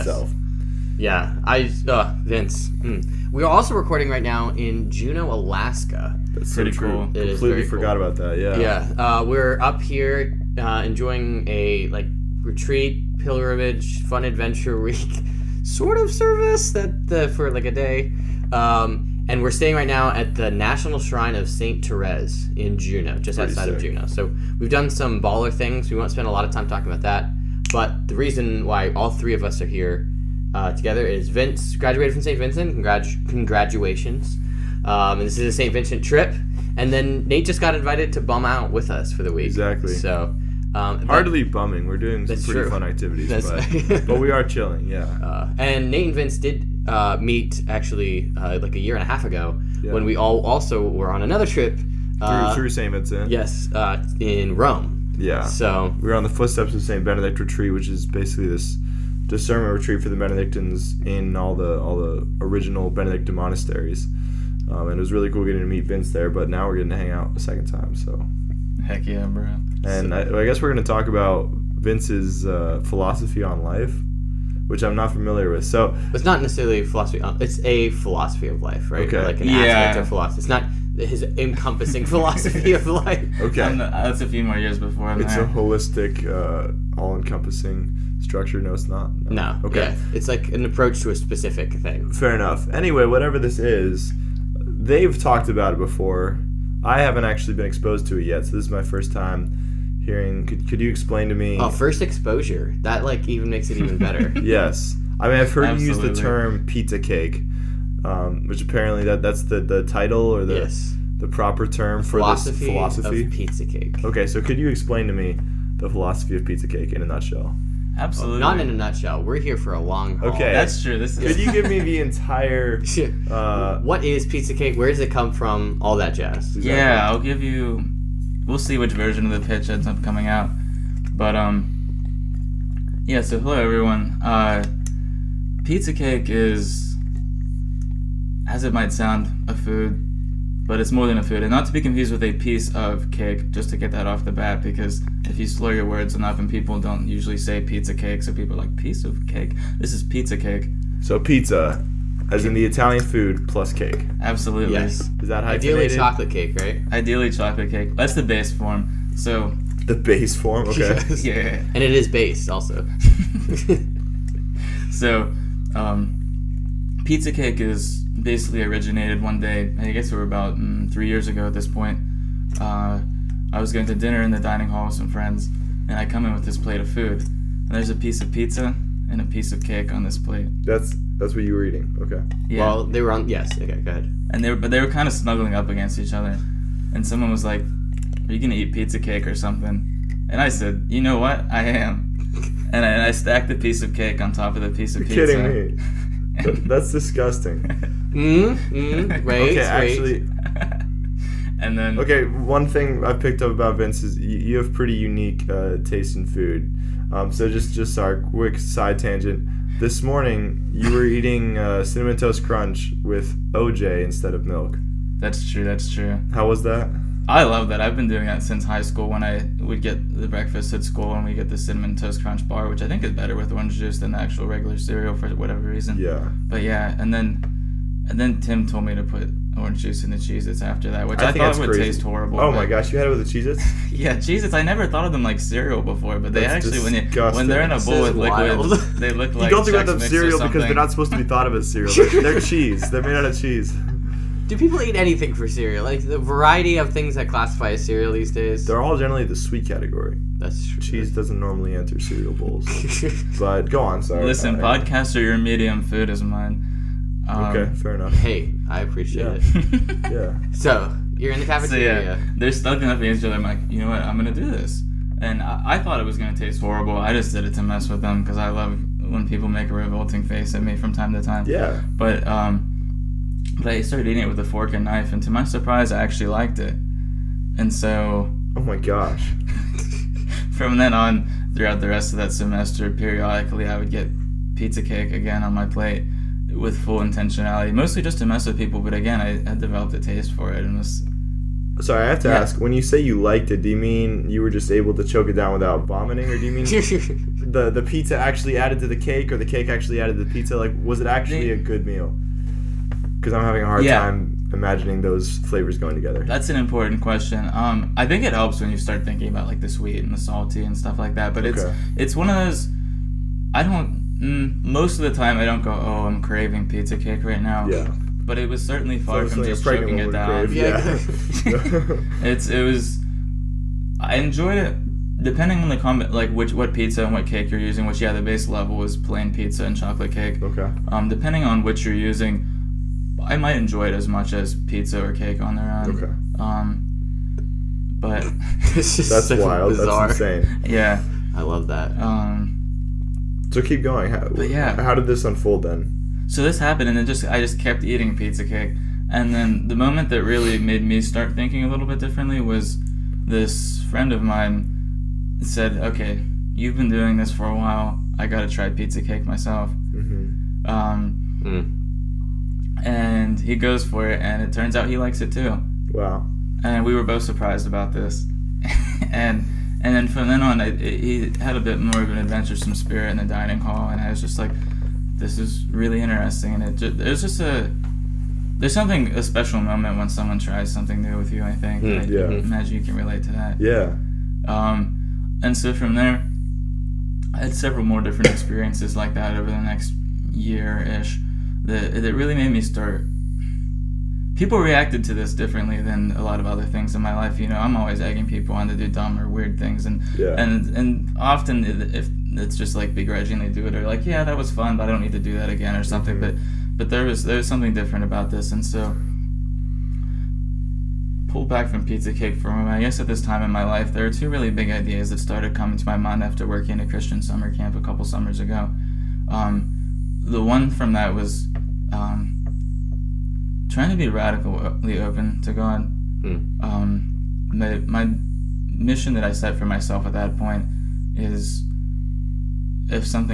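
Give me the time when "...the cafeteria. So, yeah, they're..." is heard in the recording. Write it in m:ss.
4:21.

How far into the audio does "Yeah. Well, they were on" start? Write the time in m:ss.
3:02.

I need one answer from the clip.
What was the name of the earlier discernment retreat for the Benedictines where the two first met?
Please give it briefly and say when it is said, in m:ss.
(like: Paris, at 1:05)
Footsteps of St. Benedict Retreat, at 0:56.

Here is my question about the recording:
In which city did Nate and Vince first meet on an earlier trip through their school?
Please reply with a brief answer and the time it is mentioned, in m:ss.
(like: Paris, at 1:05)
Rome, at 0:54.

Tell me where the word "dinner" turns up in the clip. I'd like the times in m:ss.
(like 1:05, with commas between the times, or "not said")
2:53.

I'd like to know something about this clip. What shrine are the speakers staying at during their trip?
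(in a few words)
National Shrine of Saint Therese.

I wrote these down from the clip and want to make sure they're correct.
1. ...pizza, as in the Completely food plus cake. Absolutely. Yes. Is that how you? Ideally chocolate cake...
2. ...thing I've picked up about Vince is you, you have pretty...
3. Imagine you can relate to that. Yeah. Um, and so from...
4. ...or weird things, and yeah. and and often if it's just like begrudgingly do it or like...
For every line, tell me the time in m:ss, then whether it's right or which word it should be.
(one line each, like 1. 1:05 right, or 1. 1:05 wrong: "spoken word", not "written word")
1. 2:31 wrong: "Italian", not "Completely"
2. 3:22 right
3. 6:22 right
4. 6:39 right.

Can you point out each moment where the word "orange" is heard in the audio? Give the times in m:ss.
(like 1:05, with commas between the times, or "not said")
3:43, 3:49.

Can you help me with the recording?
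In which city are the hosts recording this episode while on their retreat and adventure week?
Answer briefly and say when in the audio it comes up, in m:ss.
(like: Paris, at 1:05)
Juneau, Alaska, at 0:04.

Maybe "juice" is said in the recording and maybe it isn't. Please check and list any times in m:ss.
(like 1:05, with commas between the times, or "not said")
3:43, 3:49.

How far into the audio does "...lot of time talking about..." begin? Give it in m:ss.
0:26.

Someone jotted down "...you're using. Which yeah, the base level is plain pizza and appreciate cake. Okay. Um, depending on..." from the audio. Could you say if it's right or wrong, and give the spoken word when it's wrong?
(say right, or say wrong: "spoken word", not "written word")
wrong: "chocolate", not "appreciate".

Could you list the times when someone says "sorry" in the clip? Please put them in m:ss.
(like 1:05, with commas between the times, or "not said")
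4:14, 4:51.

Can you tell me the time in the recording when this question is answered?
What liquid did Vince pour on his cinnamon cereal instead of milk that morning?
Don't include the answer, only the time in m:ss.
3:33.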